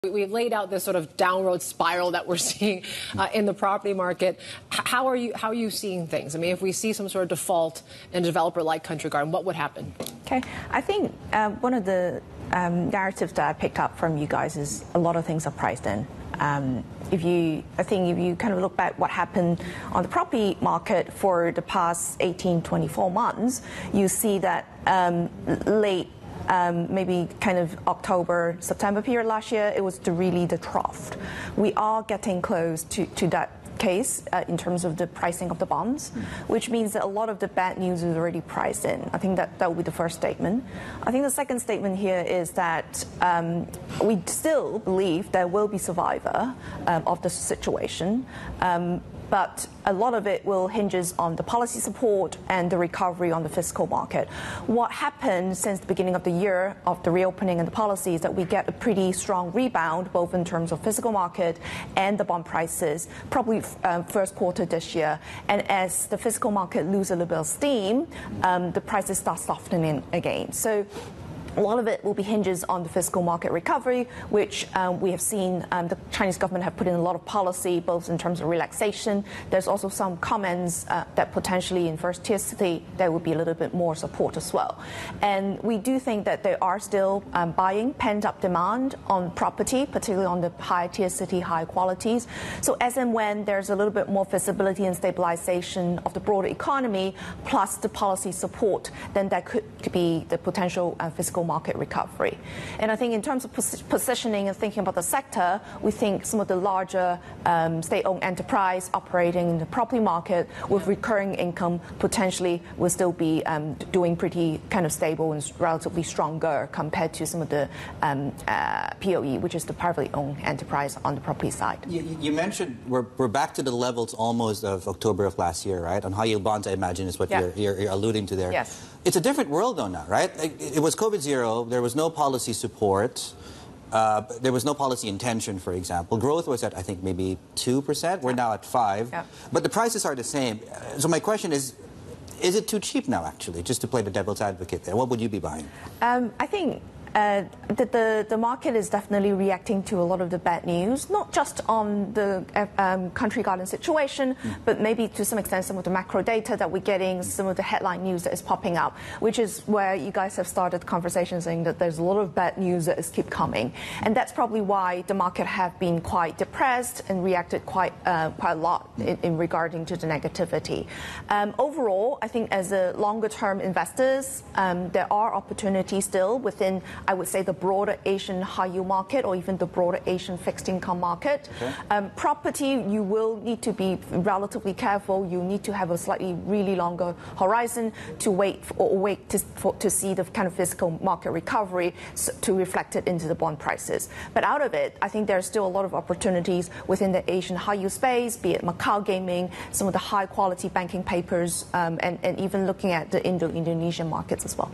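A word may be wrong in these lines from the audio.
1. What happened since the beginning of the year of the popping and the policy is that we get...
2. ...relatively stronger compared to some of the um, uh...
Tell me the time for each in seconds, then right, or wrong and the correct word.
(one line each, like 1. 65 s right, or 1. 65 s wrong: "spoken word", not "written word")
1. 54 s wrong: "reopening", not "popping"
2. 115 s right.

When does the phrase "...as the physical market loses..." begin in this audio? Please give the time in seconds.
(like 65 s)
65 s.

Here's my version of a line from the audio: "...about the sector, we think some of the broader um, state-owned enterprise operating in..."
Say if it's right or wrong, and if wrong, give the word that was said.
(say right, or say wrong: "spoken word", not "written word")
wrong: "larger", not "broader".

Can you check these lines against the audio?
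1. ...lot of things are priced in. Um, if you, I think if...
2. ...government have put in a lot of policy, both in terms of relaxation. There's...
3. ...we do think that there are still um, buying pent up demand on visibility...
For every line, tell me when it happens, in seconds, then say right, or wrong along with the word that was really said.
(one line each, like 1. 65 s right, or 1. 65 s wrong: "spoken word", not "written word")
1. 14 s right
2. 76 s right
3. 85 s wrong: "property", not "visibility".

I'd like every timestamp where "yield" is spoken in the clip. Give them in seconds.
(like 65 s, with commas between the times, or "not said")
126 s, 178 s, 197 s.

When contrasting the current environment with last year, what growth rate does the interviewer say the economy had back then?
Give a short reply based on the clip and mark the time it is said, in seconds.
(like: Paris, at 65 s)
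2%, at 137 s.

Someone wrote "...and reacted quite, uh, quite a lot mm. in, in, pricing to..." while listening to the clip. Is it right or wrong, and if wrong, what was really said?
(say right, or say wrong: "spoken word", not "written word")
wrong: "regarding", not "pricing".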